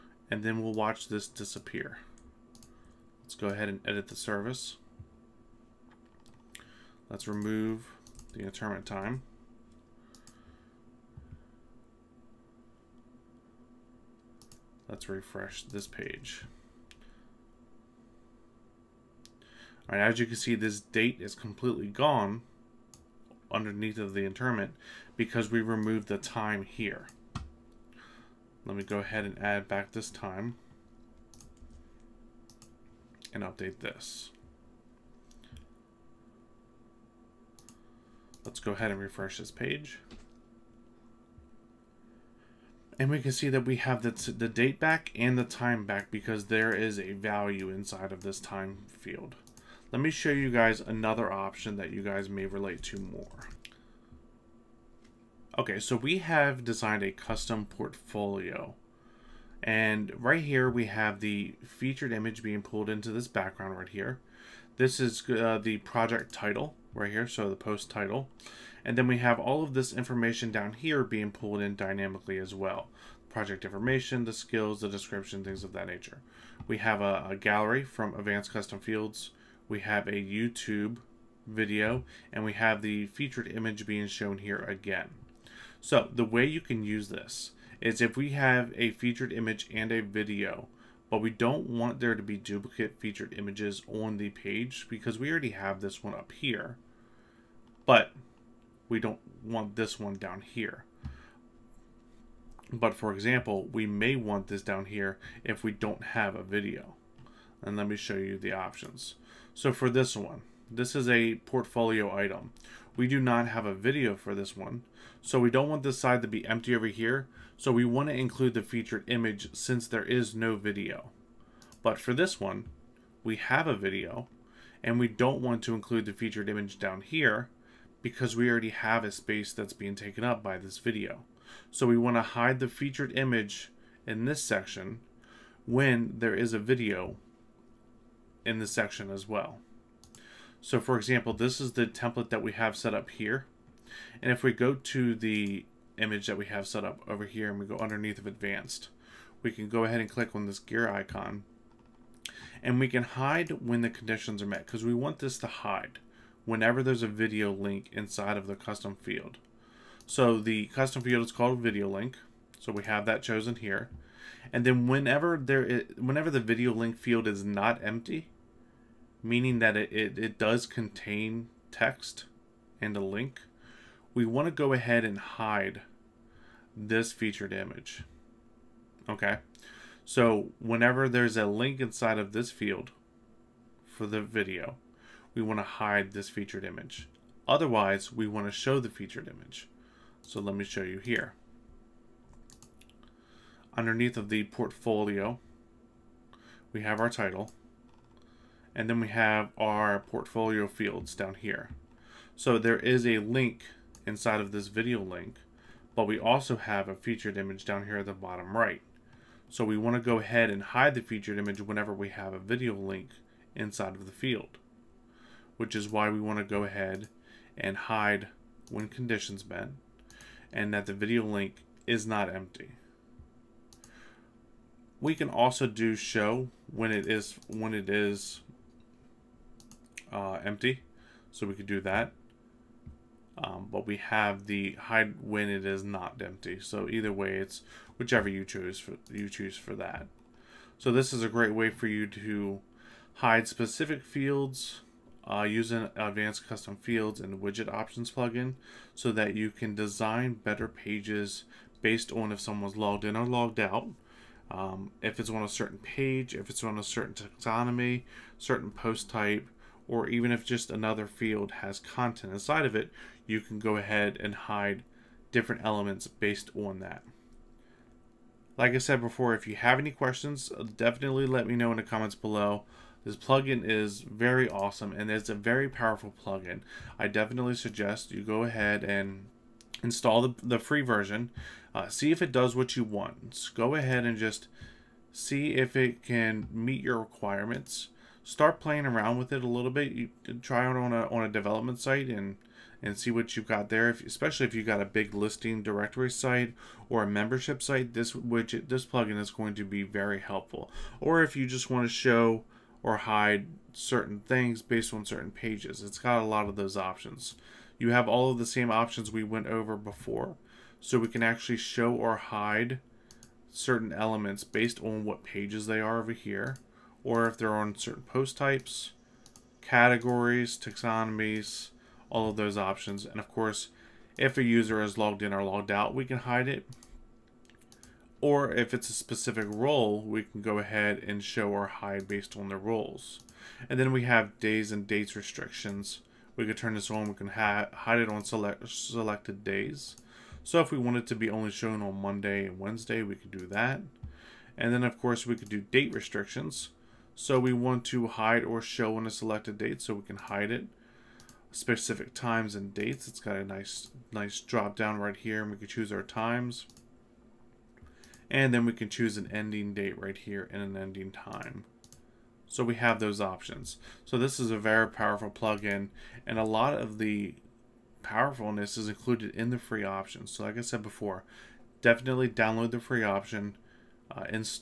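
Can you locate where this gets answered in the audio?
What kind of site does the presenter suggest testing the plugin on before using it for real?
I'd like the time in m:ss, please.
4:51.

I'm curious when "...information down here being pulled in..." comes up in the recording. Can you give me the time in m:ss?
1:09.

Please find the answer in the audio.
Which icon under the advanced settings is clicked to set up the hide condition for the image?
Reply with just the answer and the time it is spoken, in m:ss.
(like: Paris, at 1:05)
gear icon, at 2:30.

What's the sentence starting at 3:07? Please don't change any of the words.
Otherwise, we want to show the featured image.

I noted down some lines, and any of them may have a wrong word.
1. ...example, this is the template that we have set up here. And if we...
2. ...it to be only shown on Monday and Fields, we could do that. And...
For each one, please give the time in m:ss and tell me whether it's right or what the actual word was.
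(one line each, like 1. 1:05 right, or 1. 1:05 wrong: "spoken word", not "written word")
1. 2:20 right
2. 5:40 wrong: "Wednesday", not "Fields".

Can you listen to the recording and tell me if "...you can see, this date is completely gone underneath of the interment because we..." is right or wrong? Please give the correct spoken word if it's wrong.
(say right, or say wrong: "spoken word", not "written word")
right.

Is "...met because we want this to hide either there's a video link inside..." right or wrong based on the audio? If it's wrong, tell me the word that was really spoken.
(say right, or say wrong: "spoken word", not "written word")
wrong: "whenever", not "either".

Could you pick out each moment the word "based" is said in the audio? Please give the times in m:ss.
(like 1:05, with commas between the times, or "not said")
4:11, 4:26, 5:04, 5:14, 5:32.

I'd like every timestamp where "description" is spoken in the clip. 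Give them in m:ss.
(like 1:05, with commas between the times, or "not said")
1:14.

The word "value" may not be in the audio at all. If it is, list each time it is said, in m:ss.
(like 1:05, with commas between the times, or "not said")
0:47.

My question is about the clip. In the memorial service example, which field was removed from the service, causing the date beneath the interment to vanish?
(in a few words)
interment time.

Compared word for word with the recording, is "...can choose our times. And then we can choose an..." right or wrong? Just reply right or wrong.
right.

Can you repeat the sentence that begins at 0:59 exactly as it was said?
And right here, we have the featured image being pulled into this background right here.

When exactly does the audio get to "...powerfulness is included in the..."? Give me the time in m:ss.
6:08.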